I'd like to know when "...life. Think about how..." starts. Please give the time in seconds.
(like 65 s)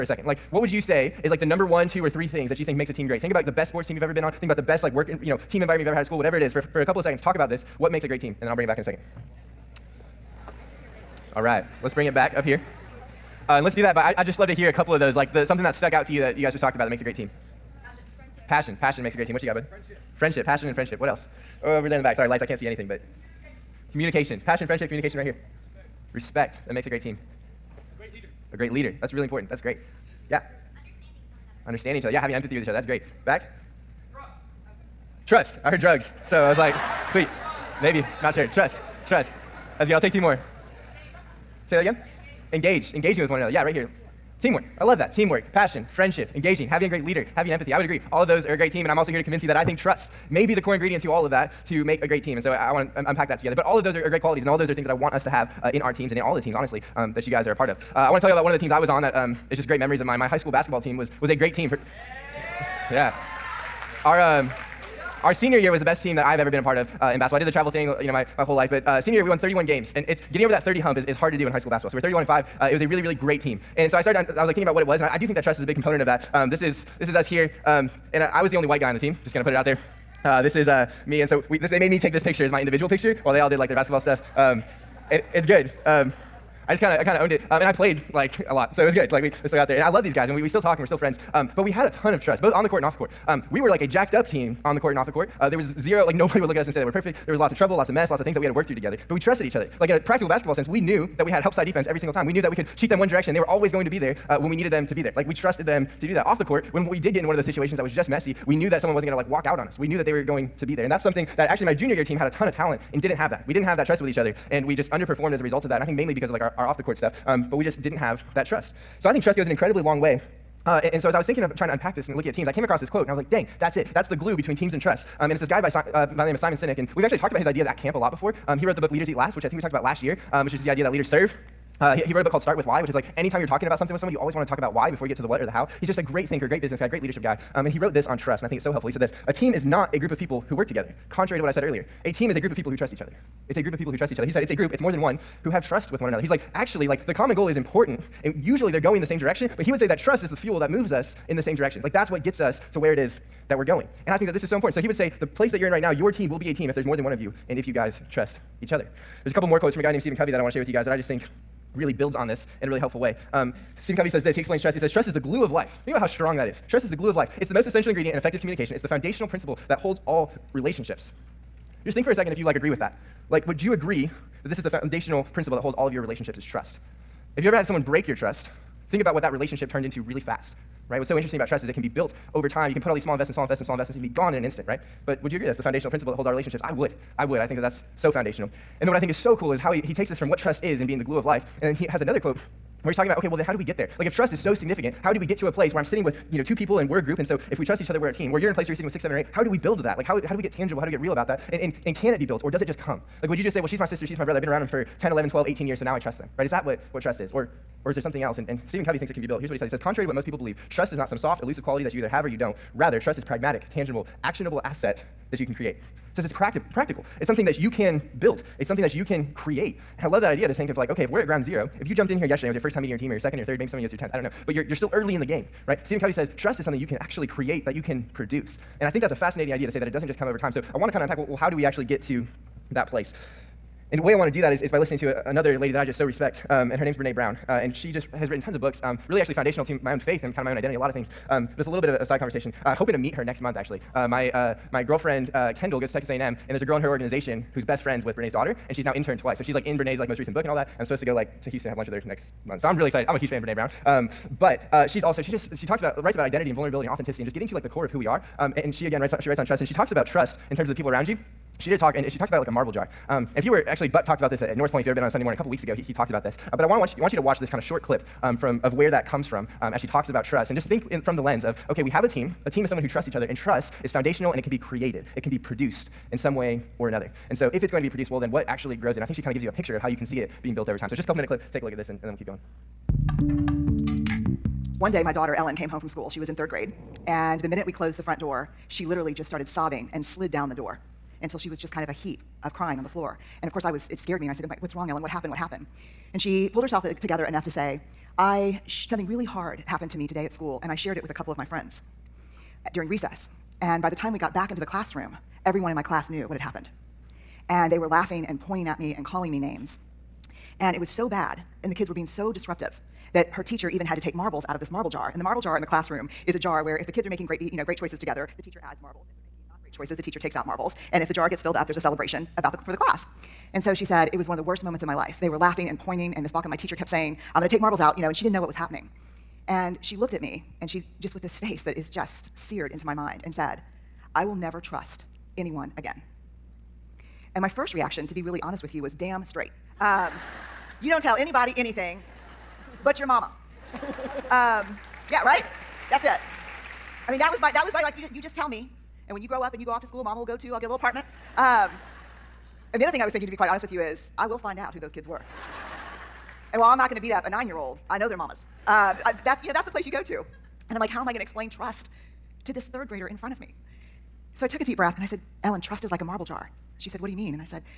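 165 s.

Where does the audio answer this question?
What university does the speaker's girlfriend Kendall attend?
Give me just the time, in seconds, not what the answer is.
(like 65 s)
245 s.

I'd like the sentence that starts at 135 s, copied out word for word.
He's just a great thinker, great business guy, great leadership guy.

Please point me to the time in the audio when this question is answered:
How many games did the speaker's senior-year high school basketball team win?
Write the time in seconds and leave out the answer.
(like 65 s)
69 s.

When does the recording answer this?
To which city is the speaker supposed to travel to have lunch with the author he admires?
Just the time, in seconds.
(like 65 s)
251 s.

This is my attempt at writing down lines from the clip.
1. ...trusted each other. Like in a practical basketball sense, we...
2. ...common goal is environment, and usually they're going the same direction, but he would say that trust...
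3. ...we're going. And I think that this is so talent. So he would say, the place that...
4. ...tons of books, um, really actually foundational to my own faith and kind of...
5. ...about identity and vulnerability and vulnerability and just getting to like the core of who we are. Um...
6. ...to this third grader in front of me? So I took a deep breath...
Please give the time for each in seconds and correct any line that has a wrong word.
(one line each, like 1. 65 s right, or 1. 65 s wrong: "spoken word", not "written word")
1. 99 s right
2. 147 s wrong: "important", not "environment"
3. 153 s wrong: "important", not "talent"
4. 238 s right
5. 256 s wrong: "authenticity", not "vulnerability"
6. 362 s right.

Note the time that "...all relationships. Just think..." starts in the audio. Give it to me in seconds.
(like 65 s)
170 s.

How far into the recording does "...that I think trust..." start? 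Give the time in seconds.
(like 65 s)
49 s.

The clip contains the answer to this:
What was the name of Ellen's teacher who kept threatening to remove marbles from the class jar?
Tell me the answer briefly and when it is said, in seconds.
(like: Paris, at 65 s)
Miss Balkan, at 326 s.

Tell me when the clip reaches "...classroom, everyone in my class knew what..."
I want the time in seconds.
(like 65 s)
304 s.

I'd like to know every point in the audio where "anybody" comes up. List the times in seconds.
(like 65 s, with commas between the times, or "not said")
341 s.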